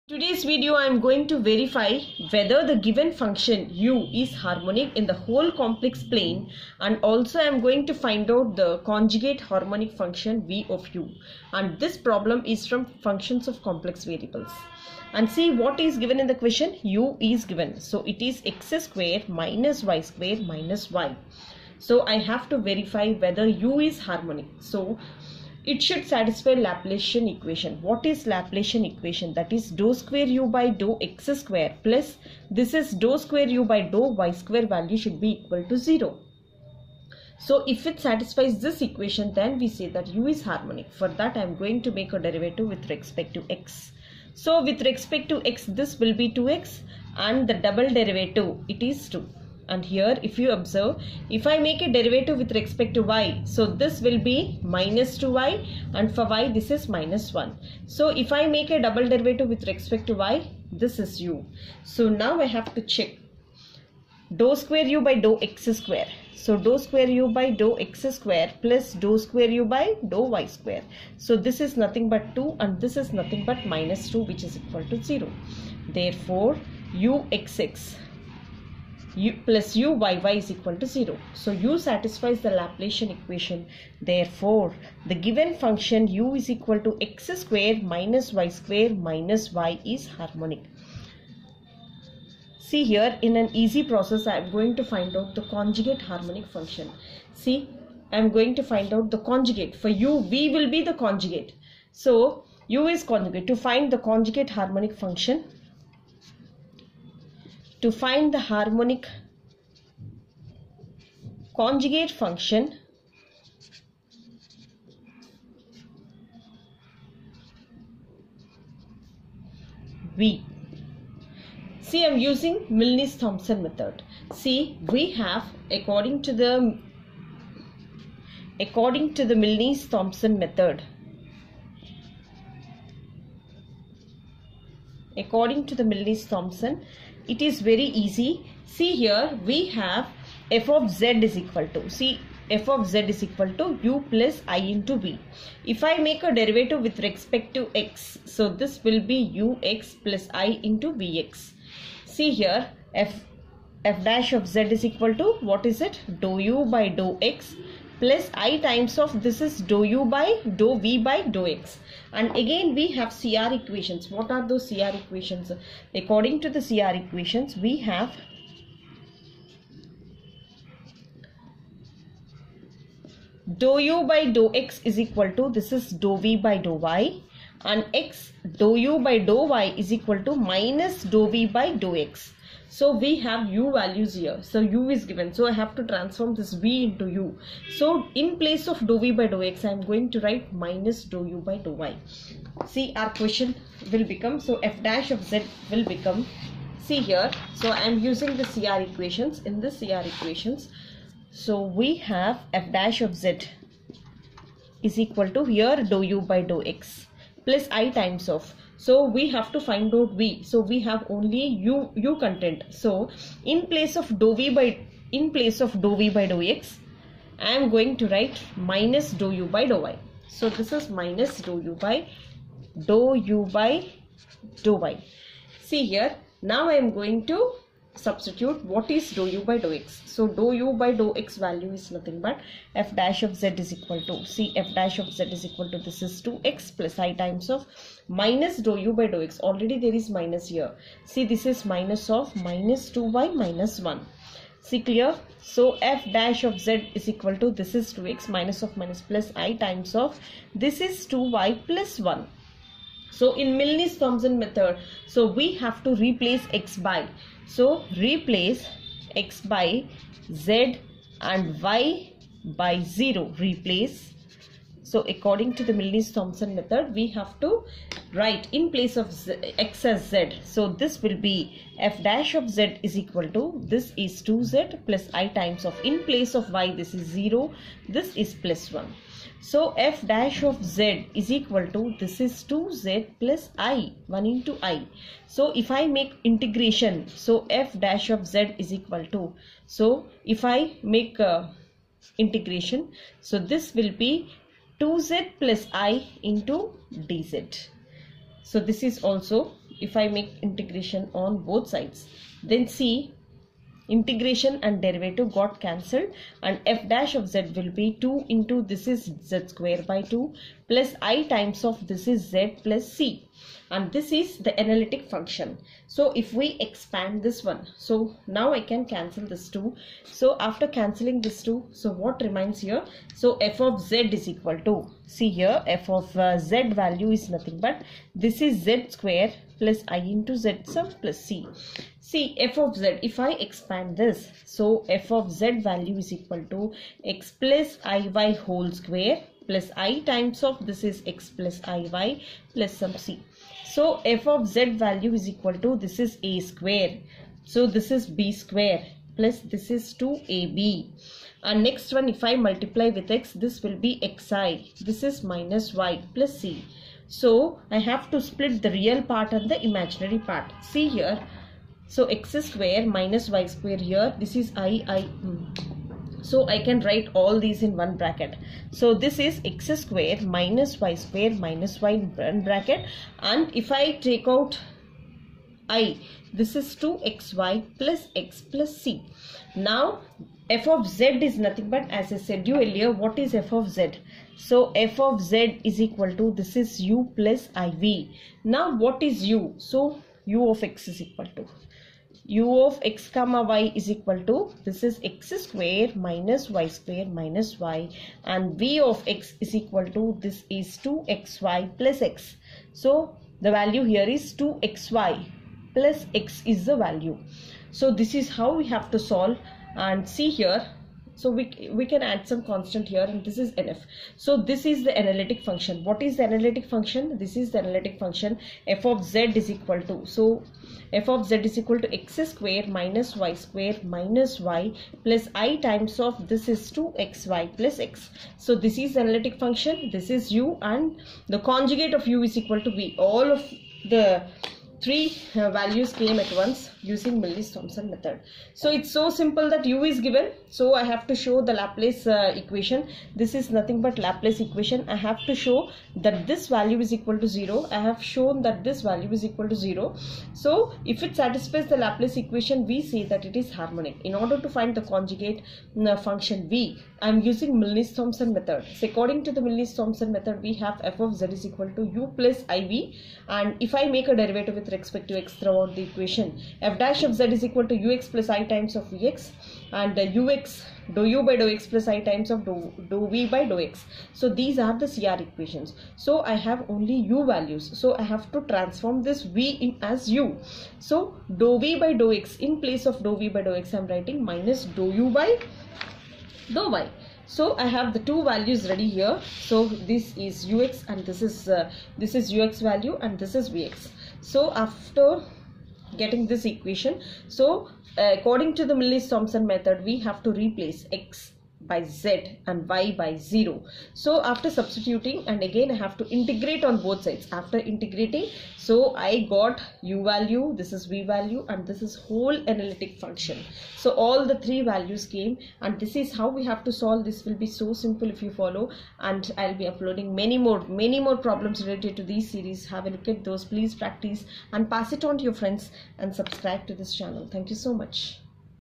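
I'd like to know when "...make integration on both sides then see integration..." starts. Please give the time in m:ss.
5:00.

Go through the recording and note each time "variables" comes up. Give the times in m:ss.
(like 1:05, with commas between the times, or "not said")
0:14.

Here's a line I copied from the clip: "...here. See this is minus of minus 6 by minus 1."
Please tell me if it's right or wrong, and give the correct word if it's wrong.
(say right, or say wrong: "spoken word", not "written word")
wrong: "2", not "6".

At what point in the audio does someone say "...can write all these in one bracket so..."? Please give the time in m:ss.
6:06.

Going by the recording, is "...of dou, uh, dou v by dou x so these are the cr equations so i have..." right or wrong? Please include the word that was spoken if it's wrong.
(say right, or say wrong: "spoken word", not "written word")
right.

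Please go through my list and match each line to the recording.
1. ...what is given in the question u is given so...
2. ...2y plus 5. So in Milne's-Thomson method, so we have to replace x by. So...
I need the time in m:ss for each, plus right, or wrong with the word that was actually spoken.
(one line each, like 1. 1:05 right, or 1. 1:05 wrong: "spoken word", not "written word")
1. 0:15 right
2. 4:11 wrong: "1", not "5".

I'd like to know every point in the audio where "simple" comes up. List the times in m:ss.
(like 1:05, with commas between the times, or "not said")
7:19, 8:37.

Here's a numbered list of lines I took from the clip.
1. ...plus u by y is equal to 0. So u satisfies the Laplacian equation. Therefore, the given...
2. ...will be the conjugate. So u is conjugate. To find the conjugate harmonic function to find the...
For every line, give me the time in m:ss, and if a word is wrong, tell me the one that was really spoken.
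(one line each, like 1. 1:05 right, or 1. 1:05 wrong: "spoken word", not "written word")
1. 1:19 right
2. 1:40 right.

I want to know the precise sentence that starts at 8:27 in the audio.
After integrating, so I got u value, this is v value and this is whole analytic function.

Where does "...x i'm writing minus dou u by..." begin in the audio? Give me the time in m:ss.
8:03.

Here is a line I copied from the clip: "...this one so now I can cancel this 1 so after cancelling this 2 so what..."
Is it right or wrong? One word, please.
wrong.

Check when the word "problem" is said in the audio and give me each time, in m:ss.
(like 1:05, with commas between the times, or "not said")
0:12, 8:41.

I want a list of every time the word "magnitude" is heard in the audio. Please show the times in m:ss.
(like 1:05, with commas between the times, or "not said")
not said.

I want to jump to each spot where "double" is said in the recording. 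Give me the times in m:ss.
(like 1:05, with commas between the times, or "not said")
0:47, 0:58.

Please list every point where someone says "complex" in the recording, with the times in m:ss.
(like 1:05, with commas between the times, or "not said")
0:05, 0:13.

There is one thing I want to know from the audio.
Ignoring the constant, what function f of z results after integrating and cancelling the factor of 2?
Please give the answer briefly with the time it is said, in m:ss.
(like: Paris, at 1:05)
z^2 + iz, at 5:28.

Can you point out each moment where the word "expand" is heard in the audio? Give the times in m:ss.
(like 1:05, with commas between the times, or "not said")
5:16, 5:33.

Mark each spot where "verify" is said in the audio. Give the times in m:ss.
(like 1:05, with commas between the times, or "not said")
0:01, 0:22.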